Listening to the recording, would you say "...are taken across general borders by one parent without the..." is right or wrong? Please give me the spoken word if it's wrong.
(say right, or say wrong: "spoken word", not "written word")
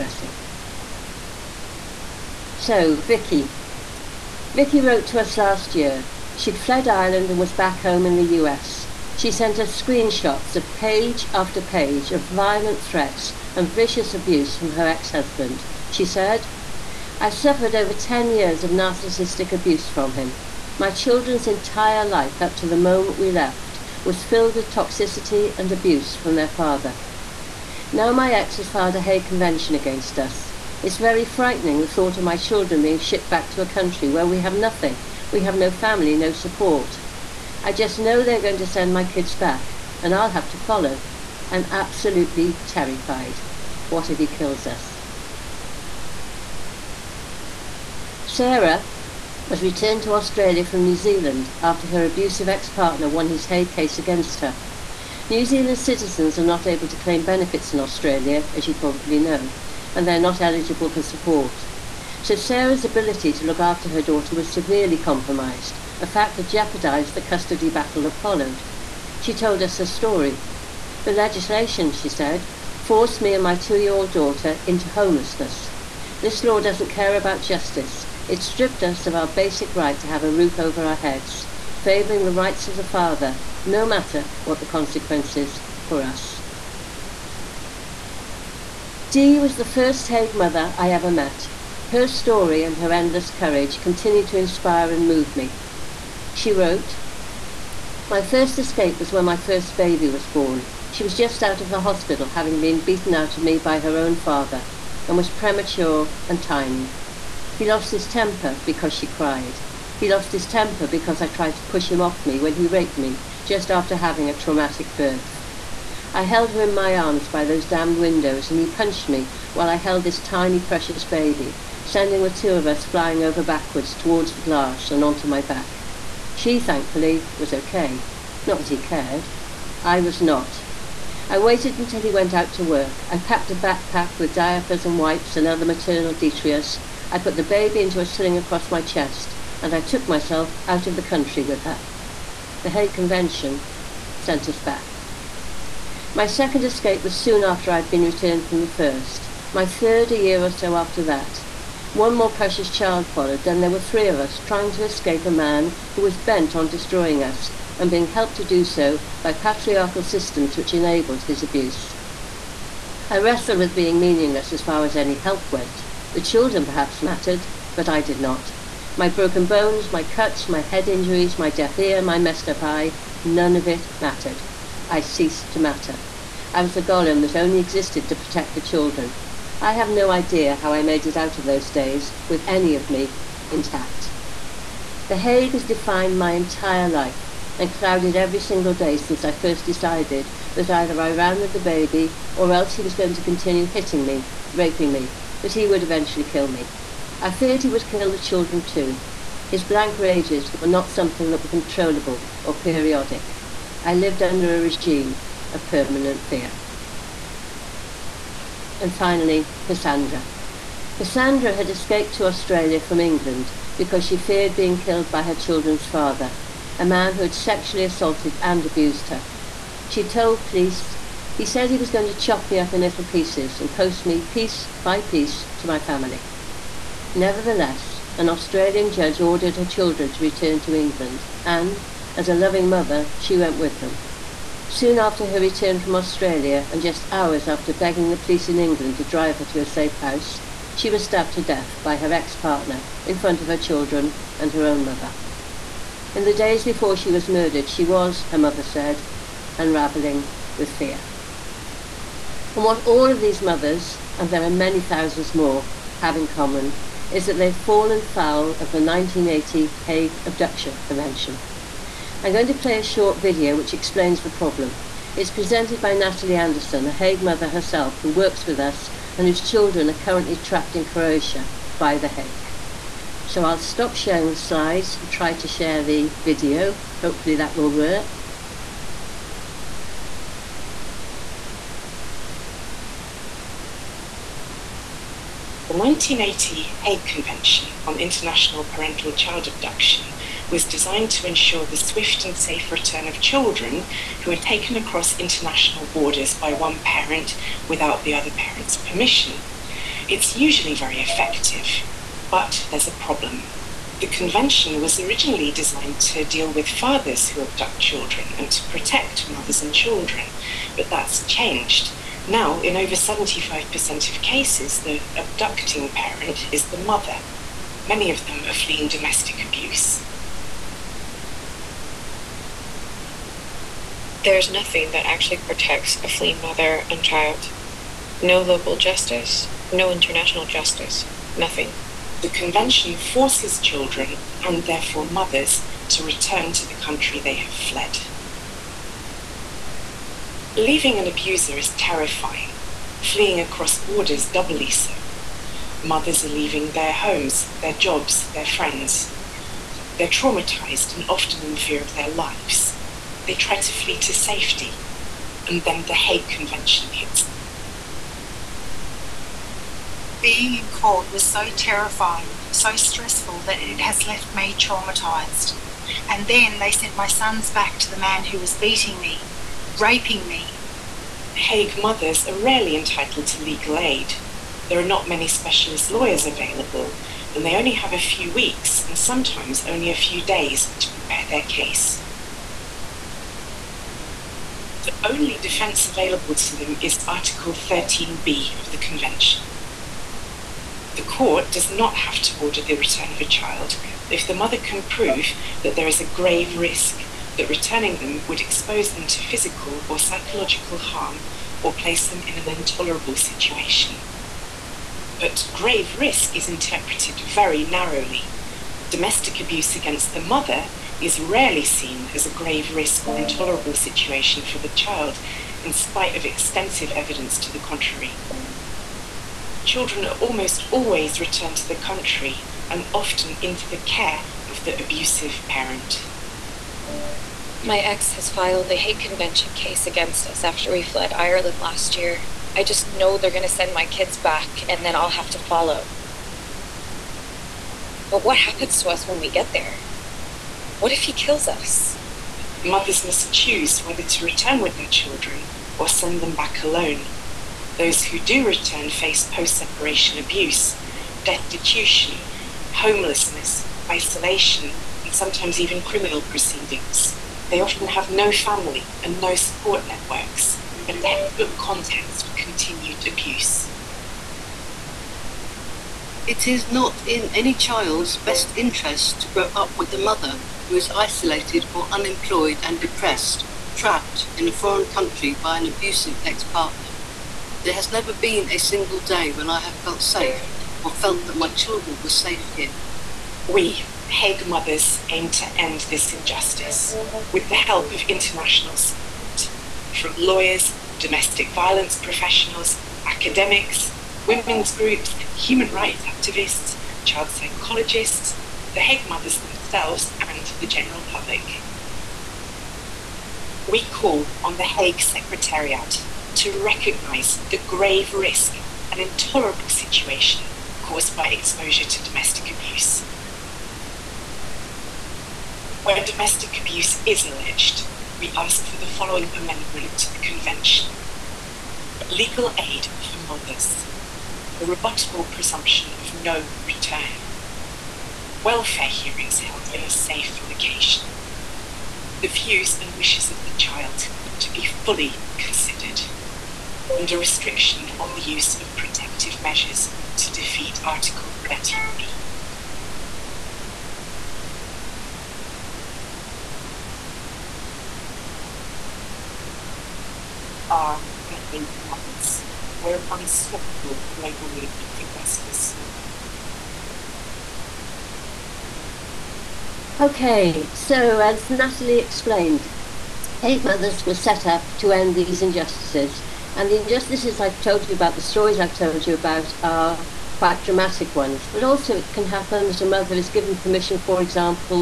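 wrong: "international", not "general".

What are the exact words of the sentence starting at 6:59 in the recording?
Children are almost always returned to the country and often into the care of the abusive parent.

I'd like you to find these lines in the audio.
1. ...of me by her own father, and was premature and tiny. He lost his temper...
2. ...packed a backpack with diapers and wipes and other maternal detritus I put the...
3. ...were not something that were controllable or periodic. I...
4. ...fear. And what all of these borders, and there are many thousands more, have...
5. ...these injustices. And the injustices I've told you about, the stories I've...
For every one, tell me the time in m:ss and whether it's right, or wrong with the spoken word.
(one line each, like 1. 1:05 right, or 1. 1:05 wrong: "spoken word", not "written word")
1. 1:43 right
2. 2:13 right
3. 3:20 right
4. 4:10 wrong: "mothers", not "borders"
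5. 9:25 right.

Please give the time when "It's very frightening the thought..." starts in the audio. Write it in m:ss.
0:30.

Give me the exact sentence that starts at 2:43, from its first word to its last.
I wrestled with being meaningless as far as any help went.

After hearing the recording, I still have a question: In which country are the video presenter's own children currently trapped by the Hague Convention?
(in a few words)
Croatia.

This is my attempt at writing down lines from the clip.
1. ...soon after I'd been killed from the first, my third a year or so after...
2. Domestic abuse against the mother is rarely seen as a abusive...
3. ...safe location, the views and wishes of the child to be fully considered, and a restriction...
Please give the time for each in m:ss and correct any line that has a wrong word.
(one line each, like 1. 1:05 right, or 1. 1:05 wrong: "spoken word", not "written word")
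1. 2:27 wrong: "returned", not "killed"
2. 6:48 wrong: "grave", not "abusive"
3. 8:49 right.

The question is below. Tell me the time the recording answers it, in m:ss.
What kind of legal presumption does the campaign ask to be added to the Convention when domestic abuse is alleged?
8:44.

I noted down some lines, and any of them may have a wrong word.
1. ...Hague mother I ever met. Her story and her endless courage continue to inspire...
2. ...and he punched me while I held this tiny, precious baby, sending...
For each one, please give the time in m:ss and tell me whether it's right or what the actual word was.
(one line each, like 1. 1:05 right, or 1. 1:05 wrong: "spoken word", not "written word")
1. 1:30 right
2. 1:58 right.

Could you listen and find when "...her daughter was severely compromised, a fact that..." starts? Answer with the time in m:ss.
1:03.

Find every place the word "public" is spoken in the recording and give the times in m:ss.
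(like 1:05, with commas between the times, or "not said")
8:21.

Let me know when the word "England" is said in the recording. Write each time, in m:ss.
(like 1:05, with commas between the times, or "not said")
3:32, 3:50, 3:58.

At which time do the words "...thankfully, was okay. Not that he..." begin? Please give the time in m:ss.
2:06.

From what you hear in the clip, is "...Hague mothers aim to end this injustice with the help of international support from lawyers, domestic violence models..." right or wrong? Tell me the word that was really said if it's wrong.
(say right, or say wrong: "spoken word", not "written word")
wrong: "professionals", not "models".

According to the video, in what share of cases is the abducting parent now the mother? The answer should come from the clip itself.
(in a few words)
over 75%.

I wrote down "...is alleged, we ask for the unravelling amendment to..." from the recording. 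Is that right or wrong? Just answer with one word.
wrong.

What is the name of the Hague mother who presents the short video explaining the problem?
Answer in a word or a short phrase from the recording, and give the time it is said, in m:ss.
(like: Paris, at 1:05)
Natalie Anderson, at 4:25.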